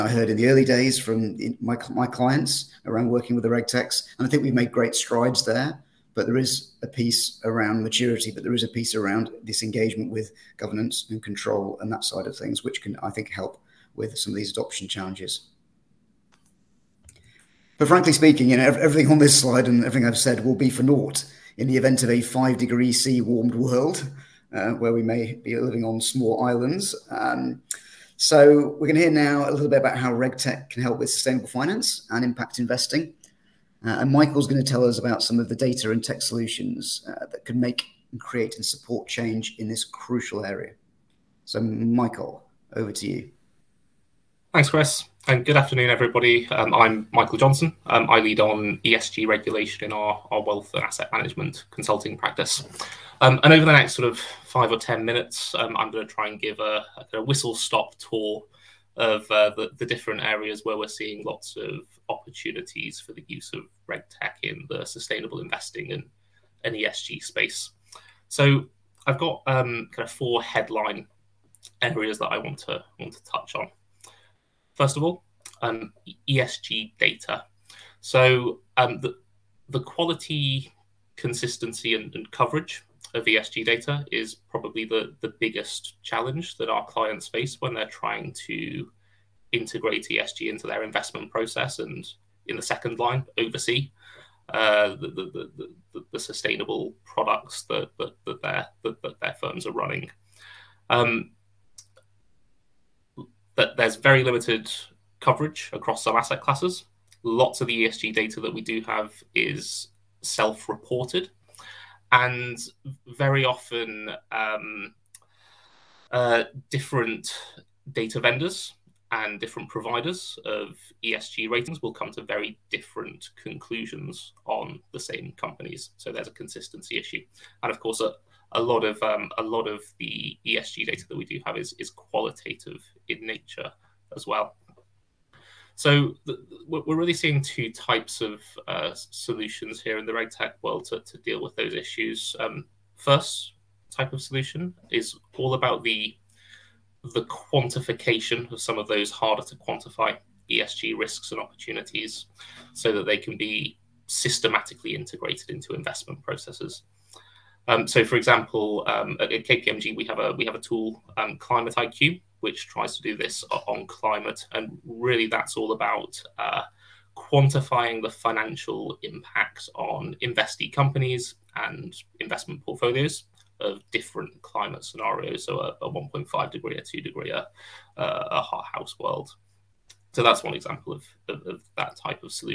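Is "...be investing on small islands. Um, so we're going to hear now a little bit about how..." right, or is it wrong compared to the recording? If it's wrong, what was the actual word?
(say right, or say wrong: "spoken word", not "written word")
wrong: "living", not "investing".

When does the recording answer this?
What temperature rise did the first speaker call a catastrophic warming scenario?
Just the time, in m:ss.
0:22.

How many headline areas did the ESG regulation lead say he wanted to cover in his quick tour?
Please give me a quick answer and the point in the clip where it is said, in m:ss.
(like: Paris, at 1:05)
4, at 1:10.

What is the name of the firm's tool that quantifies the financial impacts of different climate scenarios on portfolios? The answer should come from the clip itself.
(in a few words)
Climate IQ.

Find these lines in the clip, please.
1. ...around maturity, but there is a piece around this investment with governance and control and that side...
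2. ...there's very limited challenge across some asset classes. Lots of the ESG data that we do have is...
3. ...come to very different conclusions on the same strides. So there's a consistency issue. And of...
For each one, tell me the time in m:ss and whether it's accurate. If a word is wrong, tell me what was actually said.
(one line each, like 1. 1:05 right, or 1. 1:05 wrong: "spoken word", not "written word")
1. 0:07 wrong: "engagement", not "investment"
2. 1:43 wrong: "coverage", not "challenge"
3. 2:01 wrong: "companies", not "strides".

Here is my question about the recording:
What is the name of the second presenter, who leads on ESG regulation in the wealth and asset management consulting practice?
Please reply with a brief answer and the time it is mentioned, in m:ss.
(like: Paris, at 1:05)
Michael Johnson, at 0:47.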